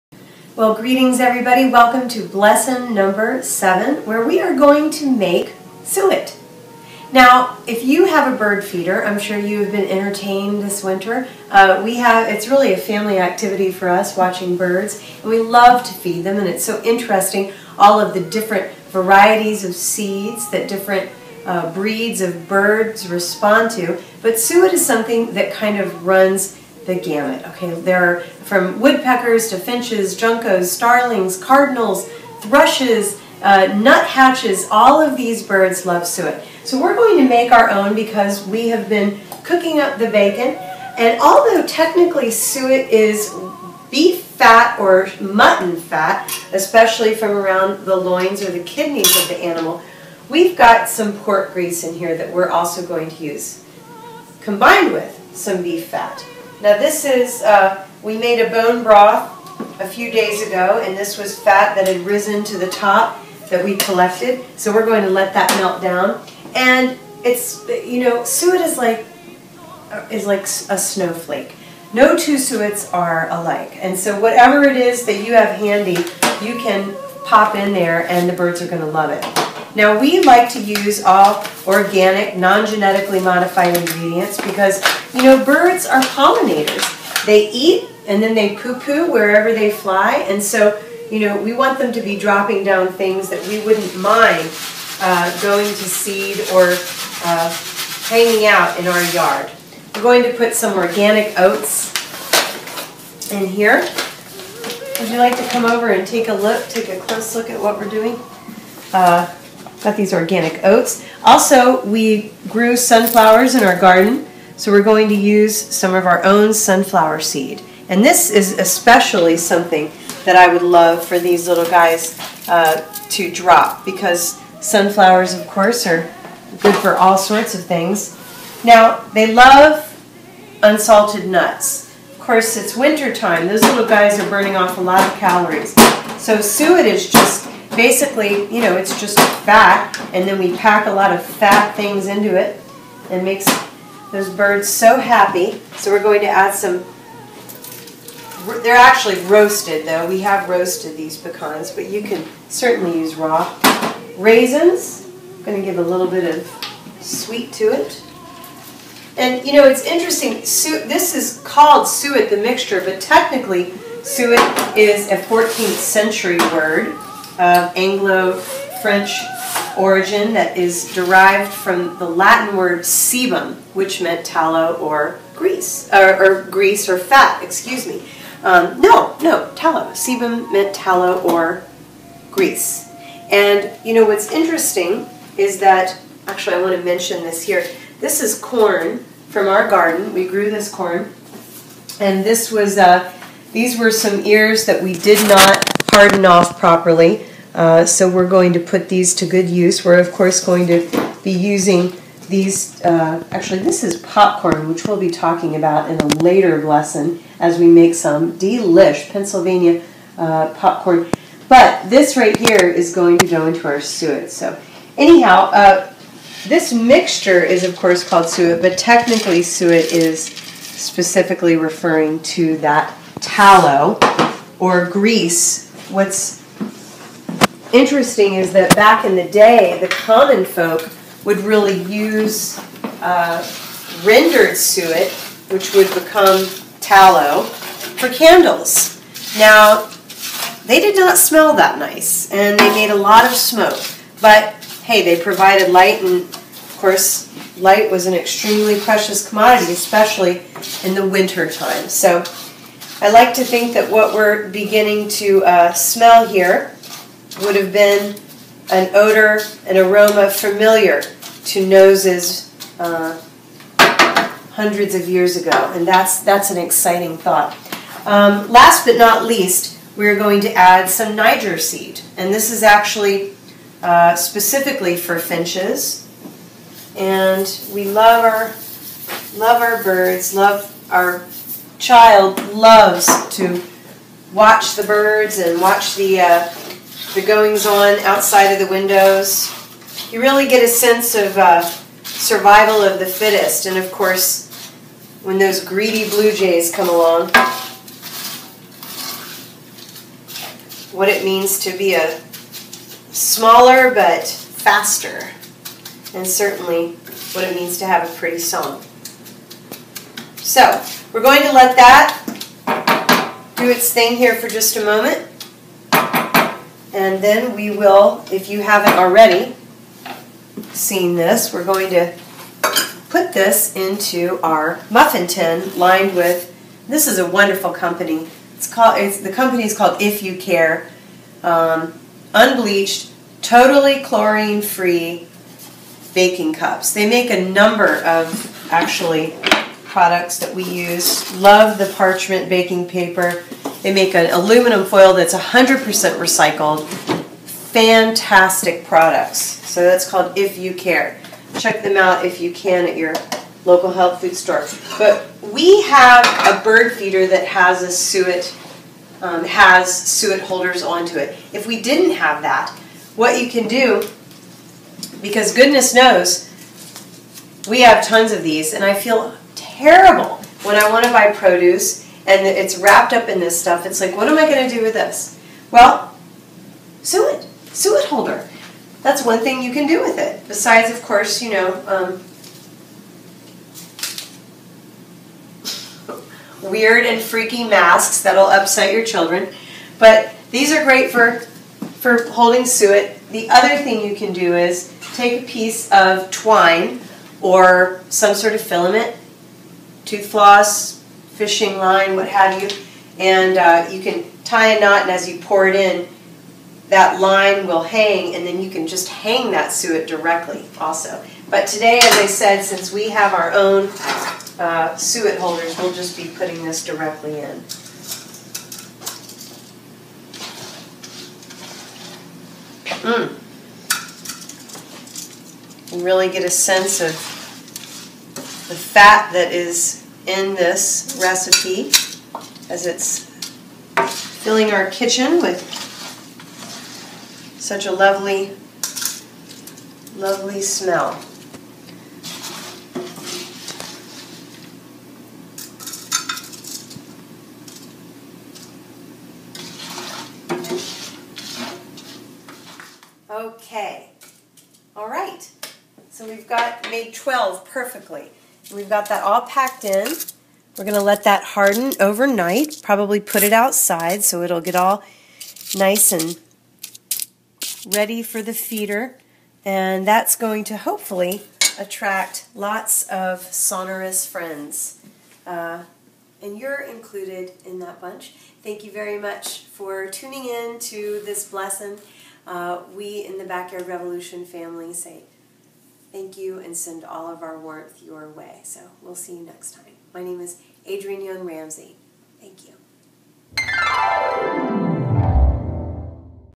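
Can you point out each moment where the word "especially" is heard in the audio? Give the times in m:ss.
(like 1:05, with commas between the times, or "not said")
0:46, 1:58, 4:09.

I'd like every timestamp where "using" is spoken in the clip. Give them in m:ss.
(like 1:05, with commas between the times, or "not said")
3:21.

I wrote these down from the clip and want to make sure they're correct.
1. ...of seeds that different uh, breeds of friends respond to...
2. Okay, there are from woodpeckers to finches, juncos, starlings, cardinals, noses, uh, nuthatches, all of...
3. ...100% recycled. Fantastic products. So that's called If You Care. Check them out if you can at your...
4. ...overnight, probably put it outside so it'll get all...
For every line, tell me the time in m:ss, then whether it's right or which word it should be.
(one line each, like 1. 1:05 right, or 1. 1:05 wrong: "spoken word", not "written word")
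1. 0:19 wrong: "birds", not "friends"
2. 0:27 wrong: "thrushes", not "noses"
3. 5:45 right
4. 7:41 right.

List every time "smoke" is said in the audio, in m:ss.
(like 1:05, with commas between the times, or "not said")
4:03.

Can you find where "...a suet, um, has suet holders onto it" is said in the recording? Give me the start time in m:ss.
5:57.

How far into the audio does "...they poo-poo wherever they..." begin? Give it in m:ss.
1:28.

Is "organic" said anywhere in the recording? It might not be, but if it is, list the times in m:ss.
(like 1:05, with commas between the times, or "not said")
1:21, 1:40, 1:50.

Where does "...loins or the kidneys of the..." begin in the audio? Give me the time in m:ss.
0:47.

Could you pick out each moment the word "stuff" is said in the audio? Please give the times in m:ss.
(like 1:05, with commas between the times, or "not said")
6:13.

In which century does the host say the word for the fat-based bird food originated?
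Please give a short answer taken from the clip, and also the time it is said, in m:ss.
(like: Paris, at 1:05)
14th century, at 2:45.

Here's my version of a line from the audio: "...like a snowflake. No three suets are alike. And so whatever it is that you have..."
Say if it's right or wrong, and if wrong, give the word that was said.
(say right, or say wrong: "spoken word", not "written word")
wrong: "two", not "three".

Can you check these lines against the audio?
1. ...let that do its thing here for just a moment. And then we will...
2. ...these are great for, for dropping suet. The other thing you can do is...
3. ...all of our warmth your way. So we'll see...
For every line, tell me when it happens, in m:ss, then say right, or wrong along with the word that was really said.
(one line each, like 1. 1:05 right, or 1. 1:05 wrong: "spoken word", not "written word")
1. 5:11 right
2. 6:30 wrong: "holding", not "dropping"
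3. 8:07 right.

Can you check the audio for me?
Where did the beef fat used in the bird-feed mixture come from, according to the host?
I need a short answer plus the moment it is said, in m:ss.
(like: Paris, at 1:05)
bone broth, at 0:58.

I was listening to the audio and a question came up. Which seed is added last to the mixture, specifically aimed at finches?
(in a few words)
Niger seed.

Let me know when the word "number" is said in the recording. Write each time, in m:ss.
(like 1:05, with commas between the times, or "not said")
0:02, 5:37.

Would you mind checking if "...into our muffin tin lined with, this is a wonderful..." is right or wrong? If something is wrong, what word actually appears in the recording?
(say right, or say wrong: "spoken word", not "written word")
right.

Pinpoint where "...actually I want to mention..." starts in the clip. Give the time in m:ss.
3:06.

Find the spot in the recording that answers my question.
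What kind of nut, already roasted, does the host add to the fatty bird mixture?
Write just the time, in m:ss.
2:31.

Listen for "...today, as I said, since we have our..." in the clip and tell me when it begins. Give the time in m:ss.
6:51.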